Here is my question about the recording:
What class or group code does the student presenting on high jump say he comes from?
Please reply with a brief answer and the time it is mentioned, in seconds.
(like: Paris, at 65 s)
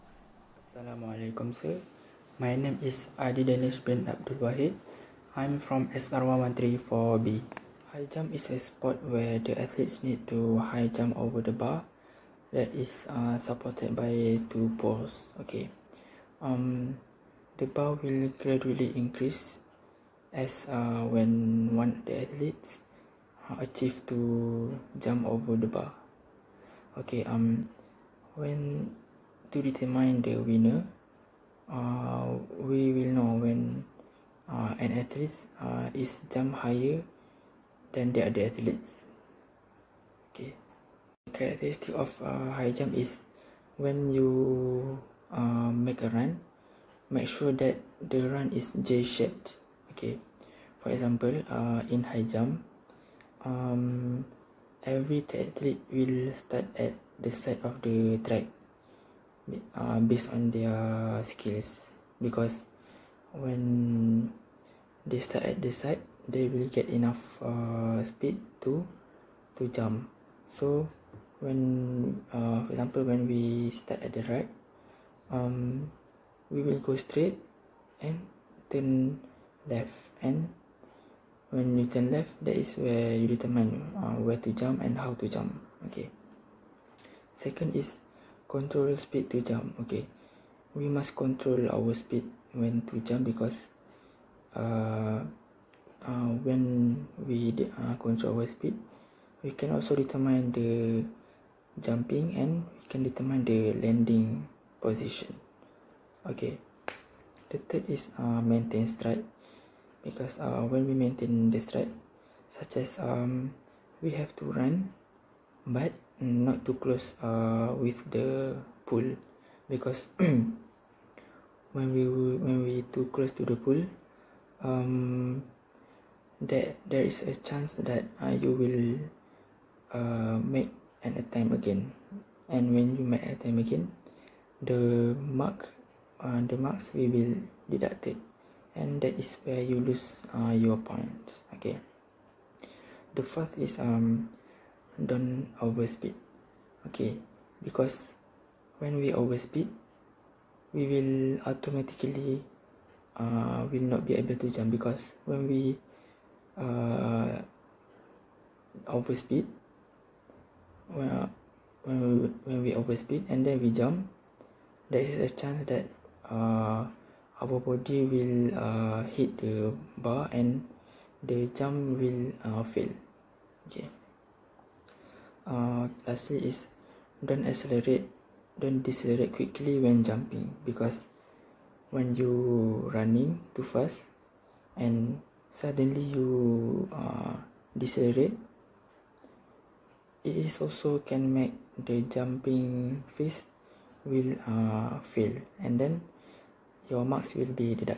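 SR113-4B, at 5 s.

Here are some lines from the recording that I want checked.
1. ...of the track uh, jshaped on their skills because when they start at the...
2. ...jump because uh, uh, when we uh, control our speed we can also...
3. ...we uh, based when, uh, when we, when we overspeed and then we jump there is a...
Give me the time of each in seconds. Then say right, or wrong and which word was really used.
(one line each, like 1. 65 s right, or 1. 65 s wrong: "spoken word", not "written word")
1. 57 s wrong: "based", not "jshaped"
2. 93 s right
3. 155 s wrong: "overspeed", not "based".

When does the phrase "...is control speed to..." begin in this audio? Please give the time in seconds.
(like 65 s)
87 s.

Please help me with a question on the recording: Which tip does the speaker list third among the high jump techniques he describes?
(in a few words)
Maintain stride.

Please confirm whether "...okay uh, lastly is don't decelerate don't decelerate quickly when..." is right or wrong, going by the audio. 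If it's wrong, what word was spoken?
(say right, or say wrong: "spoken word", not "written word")
wrong: "accelerate", not "decelerate".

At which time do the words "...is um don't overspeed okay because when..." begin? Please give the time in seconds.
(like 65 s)
143 s.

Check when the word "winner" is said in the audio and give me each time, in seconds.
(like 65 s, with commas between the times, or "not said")
30 s.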